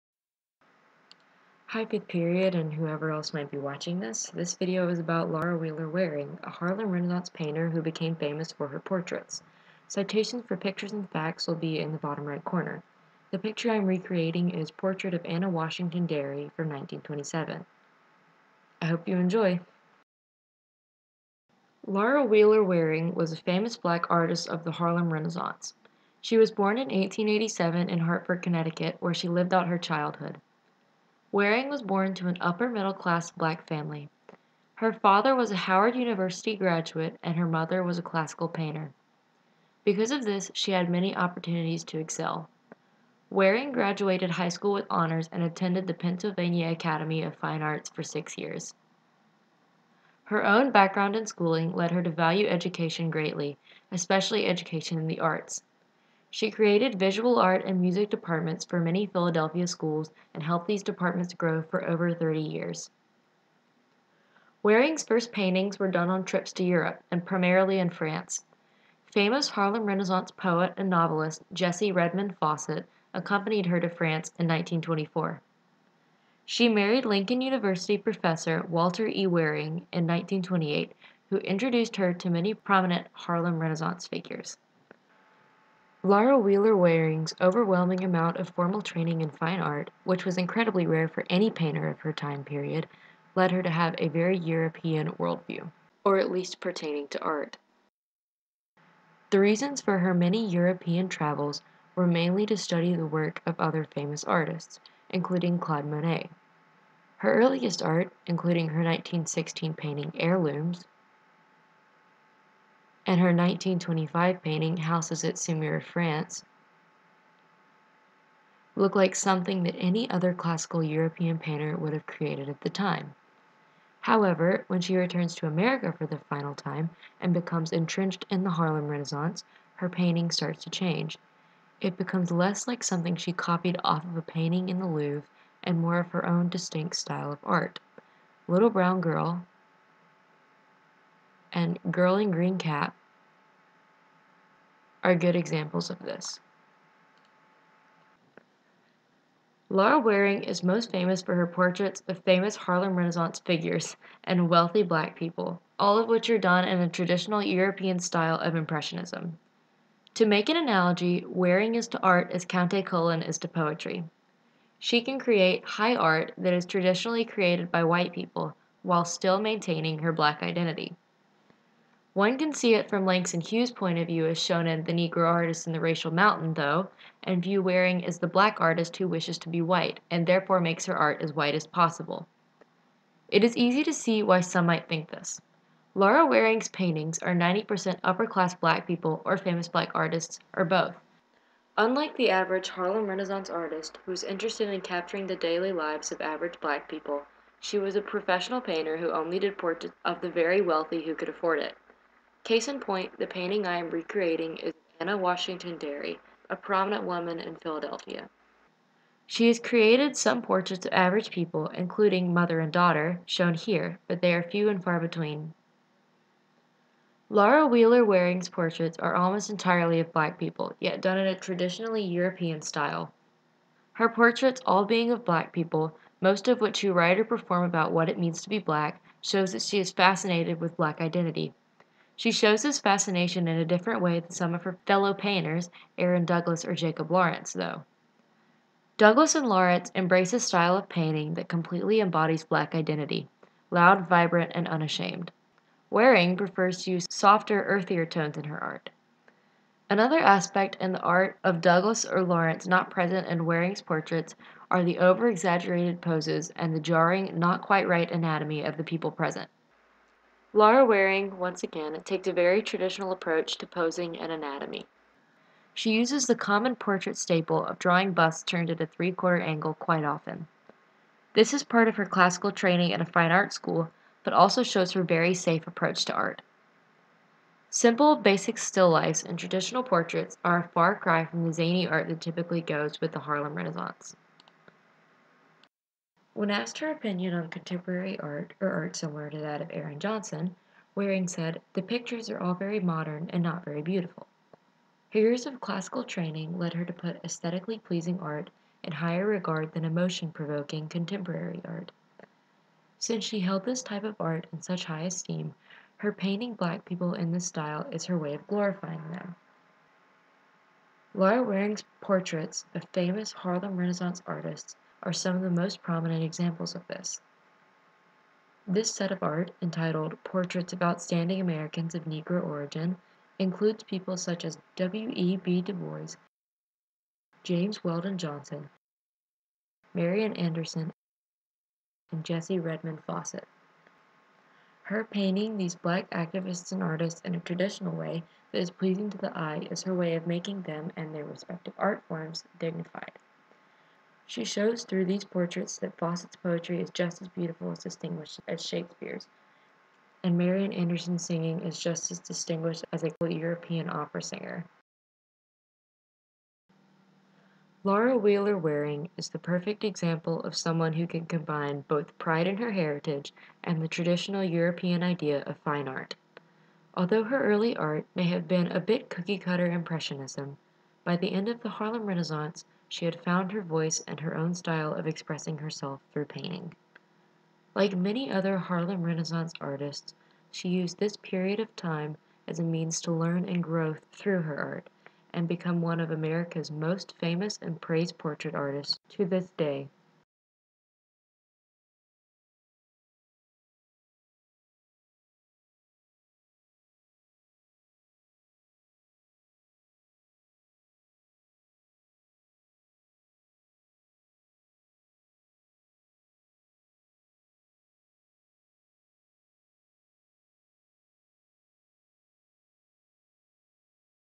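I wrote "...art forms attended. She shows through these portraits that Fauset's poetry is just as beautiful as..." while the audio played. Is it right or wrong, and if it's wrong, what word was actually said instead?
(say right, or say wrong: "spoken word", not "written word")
wrong: "dignified", not "attended".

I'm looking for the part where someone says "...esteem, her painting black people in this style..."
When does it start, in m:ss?
5:05.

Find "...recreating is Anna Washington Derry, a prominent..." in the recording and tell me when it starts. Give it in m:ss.
3:23.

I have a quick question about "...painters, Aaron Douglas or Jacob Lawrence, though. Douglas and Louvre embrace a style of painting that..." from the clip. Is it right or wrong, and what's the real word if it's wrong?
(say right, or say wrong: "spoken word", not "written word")
wrong: "Lawrence", not "Louvre".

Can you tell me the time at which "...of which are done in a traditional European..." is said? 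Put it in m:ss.
2:35.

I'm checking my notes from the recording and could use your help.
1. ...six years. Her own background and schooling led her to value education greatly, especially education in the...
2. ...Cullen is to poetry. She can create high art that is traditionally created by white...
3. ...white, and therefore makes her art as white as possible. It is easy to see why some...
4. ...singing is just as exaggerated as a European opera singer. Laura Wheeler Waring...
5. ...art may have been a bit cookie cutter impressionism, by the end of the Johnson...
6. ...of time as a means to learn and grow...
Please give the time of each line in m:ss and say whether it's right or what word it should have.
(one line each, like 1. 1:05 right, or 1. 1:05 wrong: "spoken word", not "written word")
1. 0:48 right
2. 2:42 right
3. 2:59 right
4. 5:51 wrong: "distinguished", not "exaggerated"
5. 6:07 wrong: "Harlem", not "Johnson"
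6. 6:21 right.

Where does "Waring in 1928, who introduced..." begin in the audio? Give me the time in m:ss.
1:19.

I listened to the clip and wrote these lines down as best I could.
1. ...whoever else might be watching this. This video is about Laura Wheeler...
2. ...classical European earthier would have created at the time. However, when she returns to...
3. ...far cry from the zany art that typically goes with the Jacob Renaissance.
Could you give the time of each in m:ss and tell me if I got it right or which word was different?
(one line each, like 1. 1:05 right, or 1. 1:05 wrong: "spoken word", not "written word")
1. 0:02 right
2. 2:00 wrong: "painter", not "earthier"
3. 4:40 wrong: "Harlem", not "Jacob".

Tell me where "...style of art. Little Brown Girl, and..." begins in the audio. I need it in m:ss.
2:16.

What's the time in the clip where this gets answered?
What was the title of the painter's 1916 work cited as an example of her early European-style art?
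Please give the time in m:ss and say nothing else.
1:50.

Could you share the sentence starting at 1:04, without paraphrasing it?
Waring's first paintings were done on trips to Europe and primarily in France.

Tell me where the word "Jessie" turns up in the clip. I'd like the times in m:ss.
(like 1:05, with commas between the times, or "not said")
1:11, 5:32.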